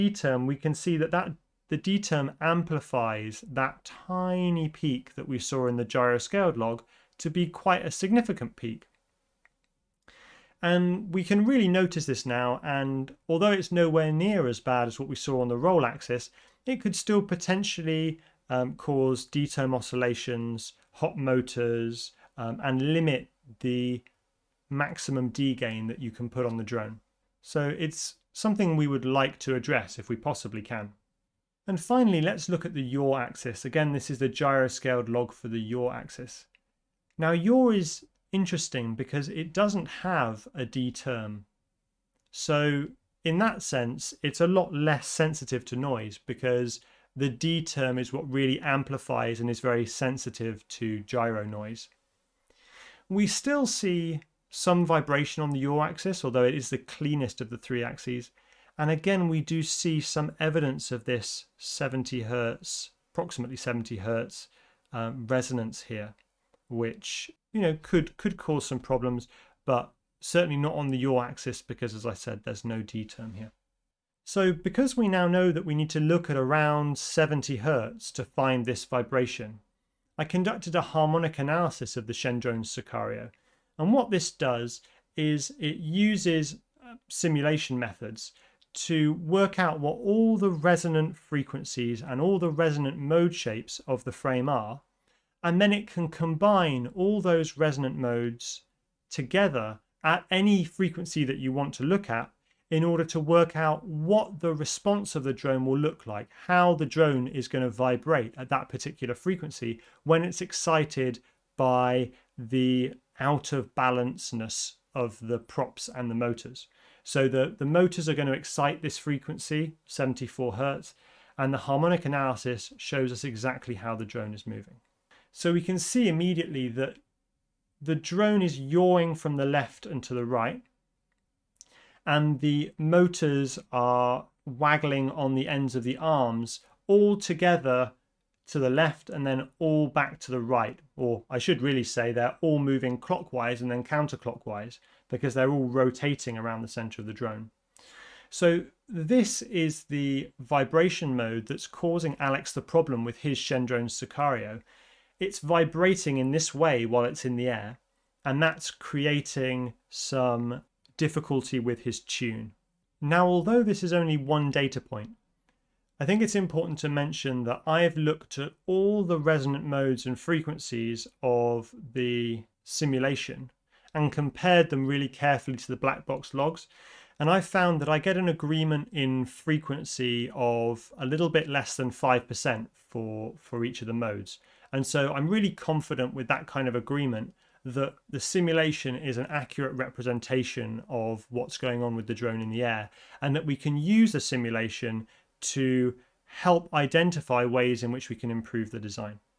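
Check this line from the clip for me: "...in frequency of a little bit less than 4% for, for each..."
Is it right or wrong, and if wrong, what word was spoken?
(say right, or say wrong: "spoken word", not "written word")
wrong: "5", not "4".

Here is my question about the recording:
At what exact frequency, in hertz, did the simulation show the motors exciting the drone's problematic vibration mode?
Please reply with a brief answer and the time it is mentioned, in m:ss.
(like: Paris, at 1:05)
74, at 1:59.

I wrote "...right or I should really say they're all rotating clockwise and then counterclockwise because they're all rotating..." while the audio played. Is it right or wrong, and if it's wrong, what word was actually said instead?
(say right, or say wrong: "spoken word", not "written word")
wrong: "moving", not "rotating".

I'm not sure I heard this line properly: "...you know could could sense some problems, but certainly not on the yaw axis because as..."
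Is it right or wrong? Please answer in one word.
wrong.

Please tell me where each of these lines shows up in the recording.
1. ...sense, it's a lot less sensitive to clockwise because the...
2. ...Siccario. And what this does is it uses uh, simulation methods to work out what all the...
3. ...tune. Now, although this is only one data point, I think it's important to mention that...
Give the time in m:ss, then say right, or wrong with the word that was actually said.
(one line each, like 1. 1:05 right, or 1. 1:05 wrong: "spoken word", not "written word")
1. 0:43 wrong: "noise", not "clockwise"
2. 1:22 right
3. 2:41 right.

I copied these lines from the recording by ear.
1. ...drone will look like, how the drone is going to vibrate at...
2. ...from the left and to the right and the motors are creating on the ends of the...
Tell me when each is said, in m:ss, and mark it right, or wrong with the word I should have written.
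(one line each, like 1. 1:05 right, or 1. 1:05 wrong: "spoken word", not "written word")
1. 1:45 right
2. 2:09 wrong: "waggling", not "creating".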